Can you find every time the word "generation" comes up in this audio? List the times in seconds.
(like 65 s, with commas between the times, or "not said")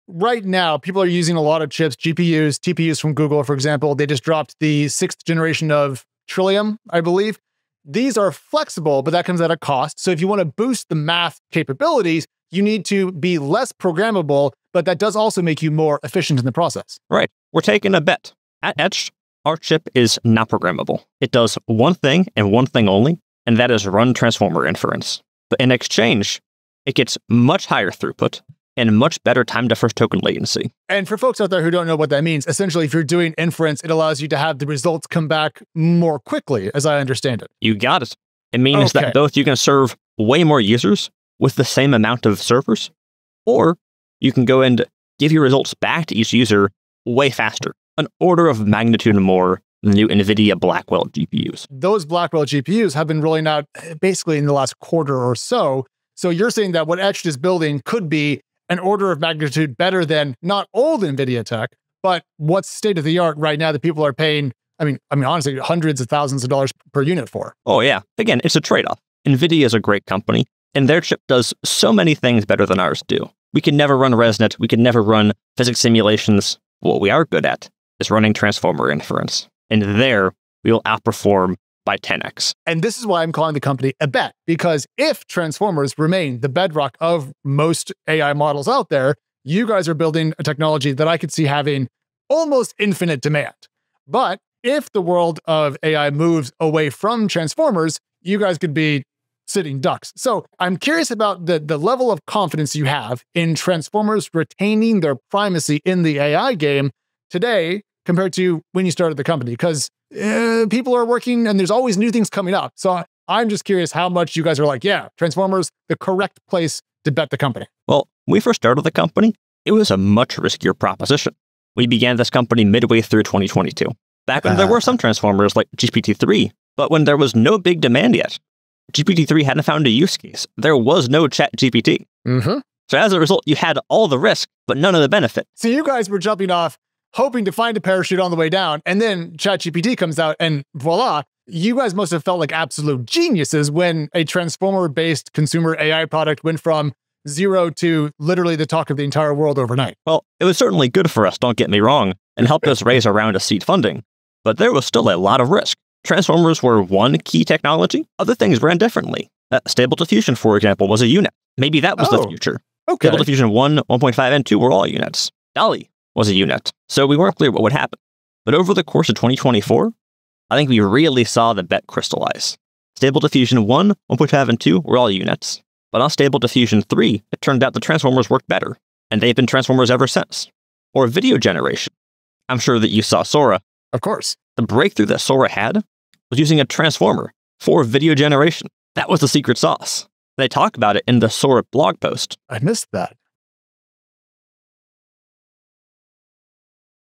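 5 s, 181 s, 188 s.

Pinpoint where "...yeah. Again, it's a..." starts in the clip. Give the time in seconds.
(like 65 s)
67 s.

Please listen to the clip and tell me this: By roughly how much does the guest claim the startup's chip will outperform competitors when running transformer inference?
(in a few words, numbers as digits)
10x.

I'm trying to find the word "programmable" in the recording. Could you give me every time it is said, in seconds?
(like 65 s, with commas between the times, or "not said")
13 s, 20 s.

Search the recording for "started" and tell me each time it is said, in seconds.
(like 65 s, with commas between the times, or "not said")
108 s, 118 s.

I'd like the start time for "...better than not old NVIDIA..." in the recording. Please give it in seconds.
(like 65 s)
59 s.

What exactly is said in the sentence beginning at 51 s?
Those Blackwell GPUs have been rolling out eh, basically in the last quarter or so.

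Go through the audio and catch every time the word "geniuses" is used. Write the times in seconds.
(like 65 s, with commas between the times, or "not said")
143 s.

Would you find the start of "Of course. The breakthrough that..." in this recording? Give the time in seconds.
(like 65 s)
183 s.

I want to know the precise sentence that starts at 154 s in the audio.
But there was still a lot of risk.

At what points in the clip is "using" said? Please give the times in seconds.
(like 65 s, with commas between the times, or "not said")
1 s, 186 s.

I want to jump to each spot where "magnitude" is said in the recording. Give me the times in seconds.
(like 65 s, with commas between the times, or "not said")
48 s, 59 s.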